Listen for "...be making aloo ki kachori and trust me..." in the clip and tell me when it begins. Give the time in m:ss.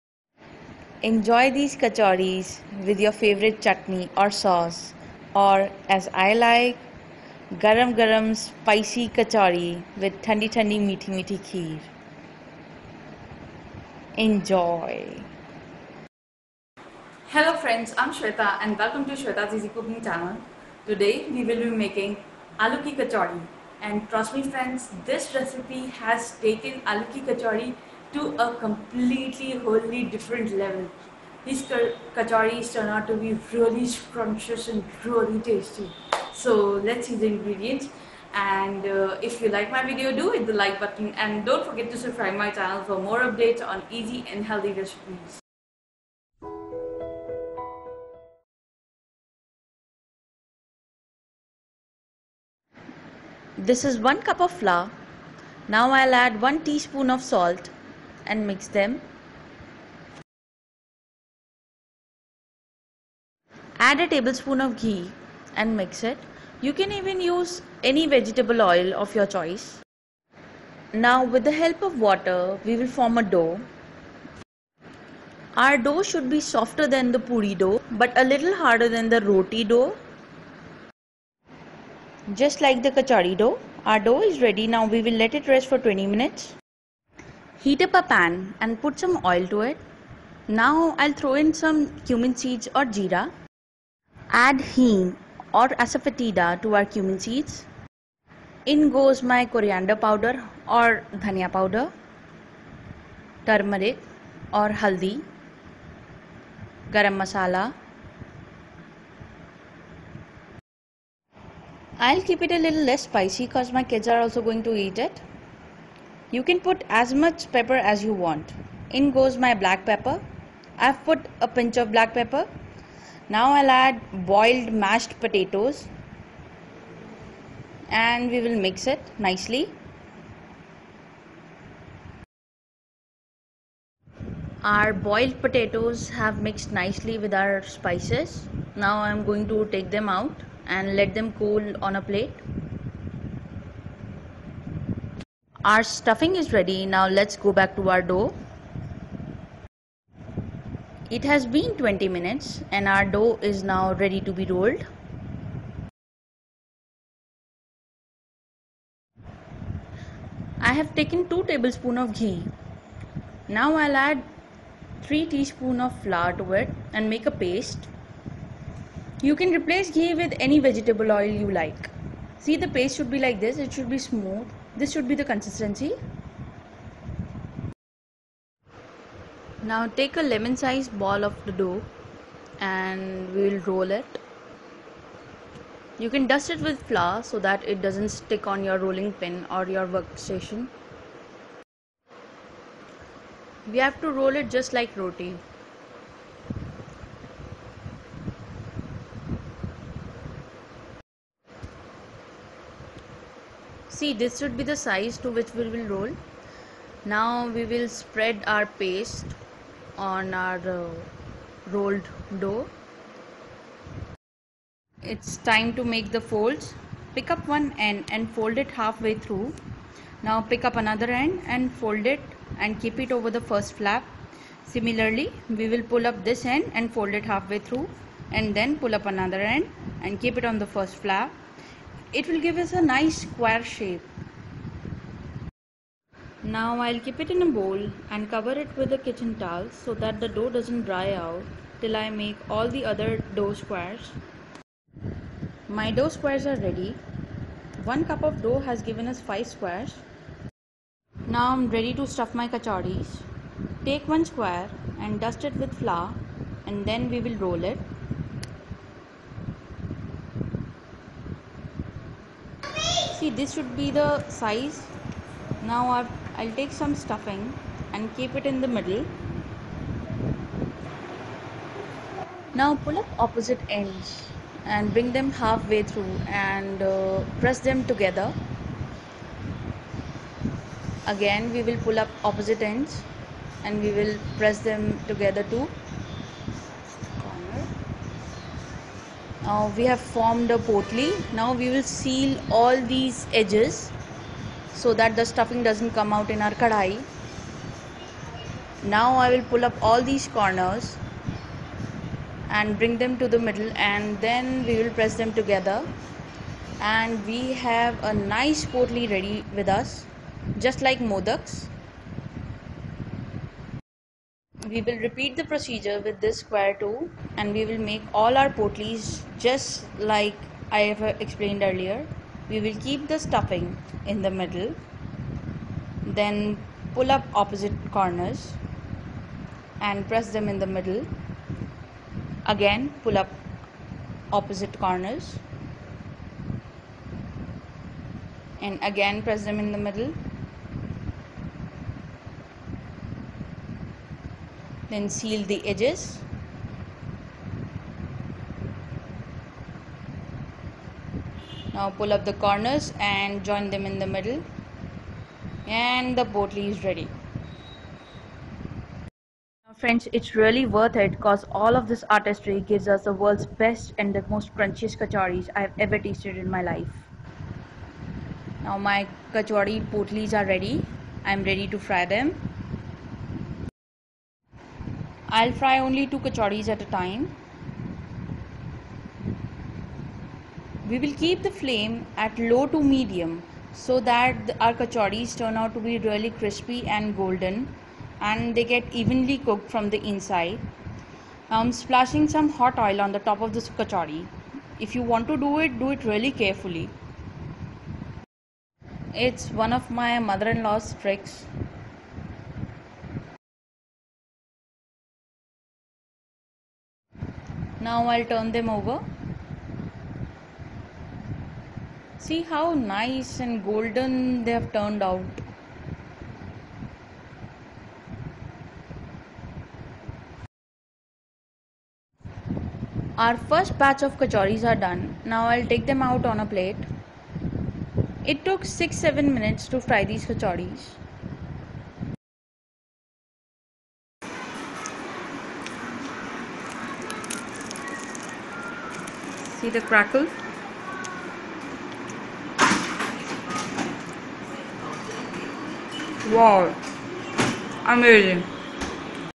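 0:21.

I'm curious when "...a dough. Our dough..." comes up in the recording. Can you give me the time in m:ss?
1:13.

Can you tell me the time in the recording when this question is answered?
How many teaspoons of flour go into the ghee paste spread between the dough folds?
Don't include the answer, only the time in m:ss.
2:45.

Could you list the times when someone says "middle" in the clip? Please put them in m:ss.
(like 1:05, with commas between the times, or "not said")
4:28, 5:03, 5:24, 5:30, 5:39, 5:54.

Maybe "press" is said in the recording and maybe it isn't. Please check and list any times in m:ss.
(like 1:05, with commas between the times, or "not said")
4:37, 4:44, 5:04, 5:30, 5:39.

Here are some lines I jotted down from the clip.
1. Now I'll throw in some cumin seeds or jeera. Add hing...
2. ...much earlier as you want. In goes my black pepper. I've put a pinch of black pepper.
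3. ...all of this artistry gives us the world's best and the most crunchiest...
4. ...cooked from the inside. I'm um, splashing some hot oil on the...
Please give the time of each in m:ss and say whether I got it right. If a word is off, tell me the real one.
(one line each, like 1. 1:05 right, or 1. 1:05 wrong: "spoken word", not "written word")
1. 1:30 right
2. 1:57 wrong: "pepper", not "earlier"
3. 6:01 right
4. 6:29 right.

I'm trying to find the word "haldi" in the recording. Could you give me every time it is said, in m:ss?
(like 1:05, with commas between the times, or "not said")
1:44.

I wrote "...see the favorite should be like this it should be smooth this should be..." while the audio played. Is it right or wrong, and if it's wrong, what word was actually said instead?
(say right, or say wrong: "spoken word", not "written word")
wrong: "paste", not "favorite".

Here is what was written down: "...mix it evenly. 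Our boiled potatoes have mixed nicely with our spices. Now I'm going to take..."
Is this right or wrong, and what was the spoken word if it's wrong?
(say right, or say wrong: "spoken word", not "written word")
wrong: "nicely", not "evenly".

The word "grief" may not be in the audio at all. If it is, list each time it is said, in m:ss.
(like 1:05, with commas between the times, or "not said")
not said.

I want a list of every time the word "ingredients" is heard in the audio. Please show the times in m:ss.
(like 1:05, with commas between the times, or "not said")
0:37.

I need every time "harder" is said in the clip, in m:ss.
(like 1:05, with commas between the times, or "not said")
1:18.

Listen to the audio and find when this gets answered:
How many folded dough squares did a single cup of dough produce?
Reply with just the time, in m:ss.
4:09.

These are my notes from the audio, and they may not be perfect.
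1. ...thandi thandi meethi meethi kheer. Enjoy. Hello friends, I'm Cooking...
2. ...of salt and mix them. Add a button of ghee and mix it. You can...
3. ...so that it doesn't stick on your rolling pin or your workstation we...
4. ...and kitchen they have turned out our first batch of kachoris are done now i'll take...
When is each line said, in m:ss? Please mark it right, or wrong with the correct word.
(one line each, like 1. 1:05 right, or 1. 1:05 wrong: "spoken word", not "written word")
1. 0:10 wrong: "Shweta", not "Cooking"
2. 0:57 wrong: "tablespoon", not "button"
3. 3:07 right
4. 6:53 wrong: "golden", not "kitchen".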